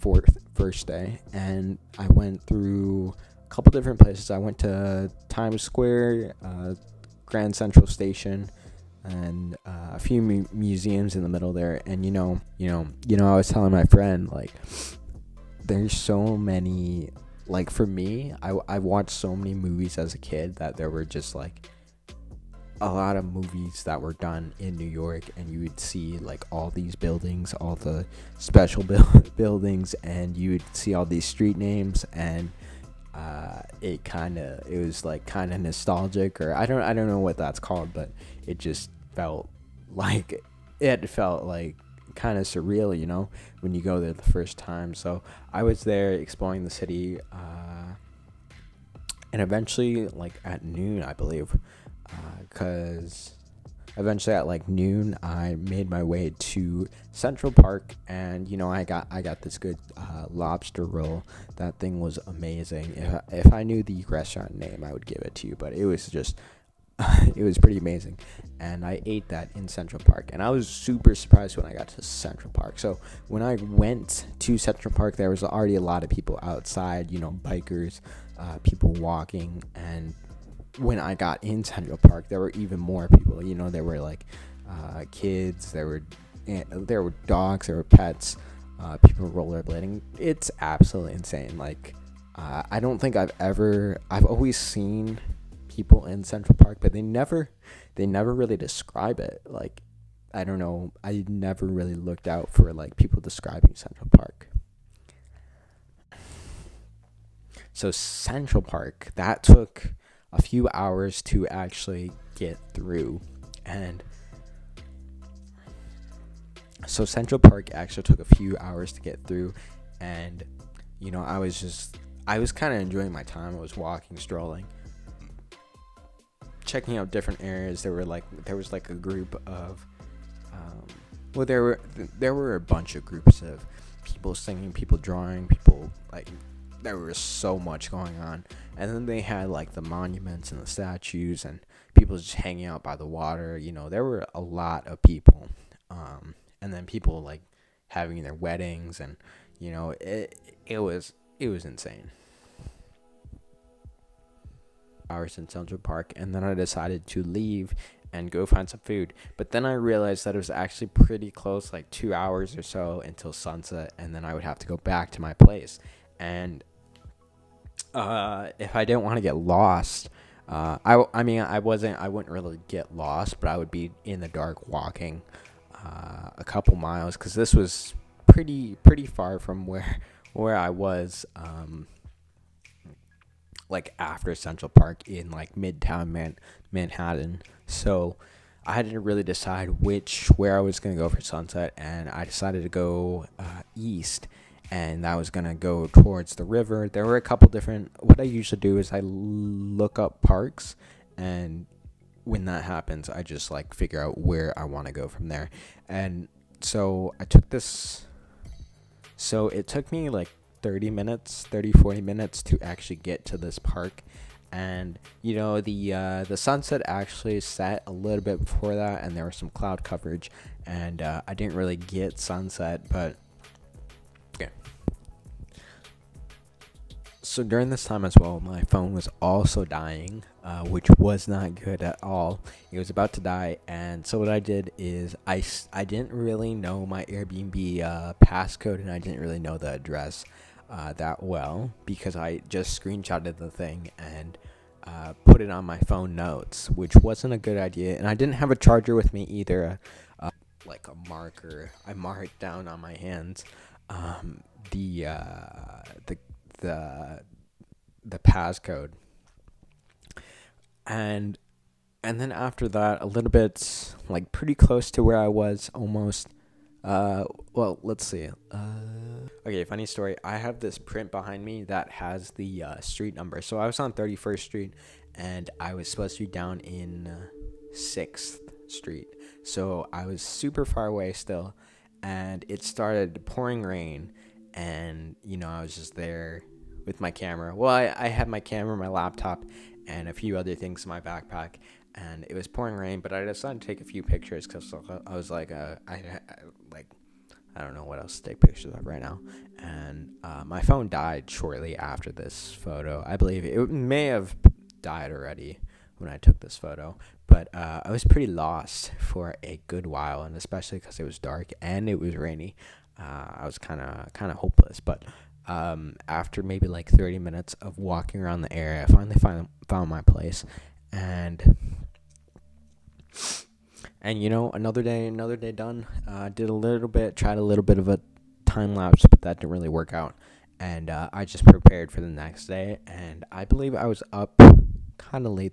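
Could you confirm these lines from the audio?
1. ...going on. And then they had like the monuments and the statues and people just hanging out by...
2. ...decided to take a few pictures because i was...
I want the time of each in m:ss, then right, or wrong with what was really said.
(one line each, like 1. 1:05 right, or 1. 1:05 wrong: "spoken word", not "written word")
1. 2:17 right
2. 4:53 right.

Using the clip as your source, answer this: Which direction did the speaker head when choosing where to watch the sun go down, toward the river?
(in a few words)
east.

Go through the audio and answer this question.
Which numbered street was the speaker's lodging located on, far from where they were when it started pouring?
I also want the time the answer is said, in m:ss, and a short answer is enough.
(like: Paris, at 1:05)
6th Street, at 4:37.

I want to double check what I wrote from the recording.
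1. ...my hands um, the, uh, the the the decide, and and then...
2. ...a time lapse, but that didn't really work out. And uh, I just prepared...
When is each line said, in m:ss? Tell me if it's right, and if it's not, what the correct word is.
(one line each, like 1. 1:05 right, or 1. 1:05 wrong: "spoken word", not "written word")
1. 4:12 wrong: "passcode", not "decide"
2. 5:27 right.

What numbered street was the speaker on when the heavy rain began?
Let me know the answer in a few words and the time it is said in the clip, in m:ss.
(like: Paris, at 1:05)
31st Street, at 4:33.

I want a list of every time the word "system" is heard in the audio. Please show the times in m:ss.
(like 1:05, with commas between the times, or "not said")
not said.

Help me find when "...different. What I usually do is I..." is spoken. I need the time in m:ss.
3:17.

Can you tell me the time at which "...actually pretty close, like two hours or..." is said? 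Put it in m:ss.
2:40.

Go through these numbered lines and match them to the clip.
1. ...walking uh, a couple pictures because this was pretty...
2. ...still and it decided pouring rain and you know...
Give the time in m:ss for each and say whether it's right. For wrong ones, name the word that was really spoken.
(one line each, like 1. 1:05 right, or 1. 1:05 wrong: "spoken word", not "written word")
1. 2:54 wrong: "miles", not "pictures"
2. 4:41 wrong: "started", not "decided".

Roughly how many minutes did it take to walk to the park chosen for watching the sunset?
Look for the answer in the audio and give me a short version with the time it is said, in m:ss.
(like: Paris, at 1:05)
30 to 40 minutes, at 3:31.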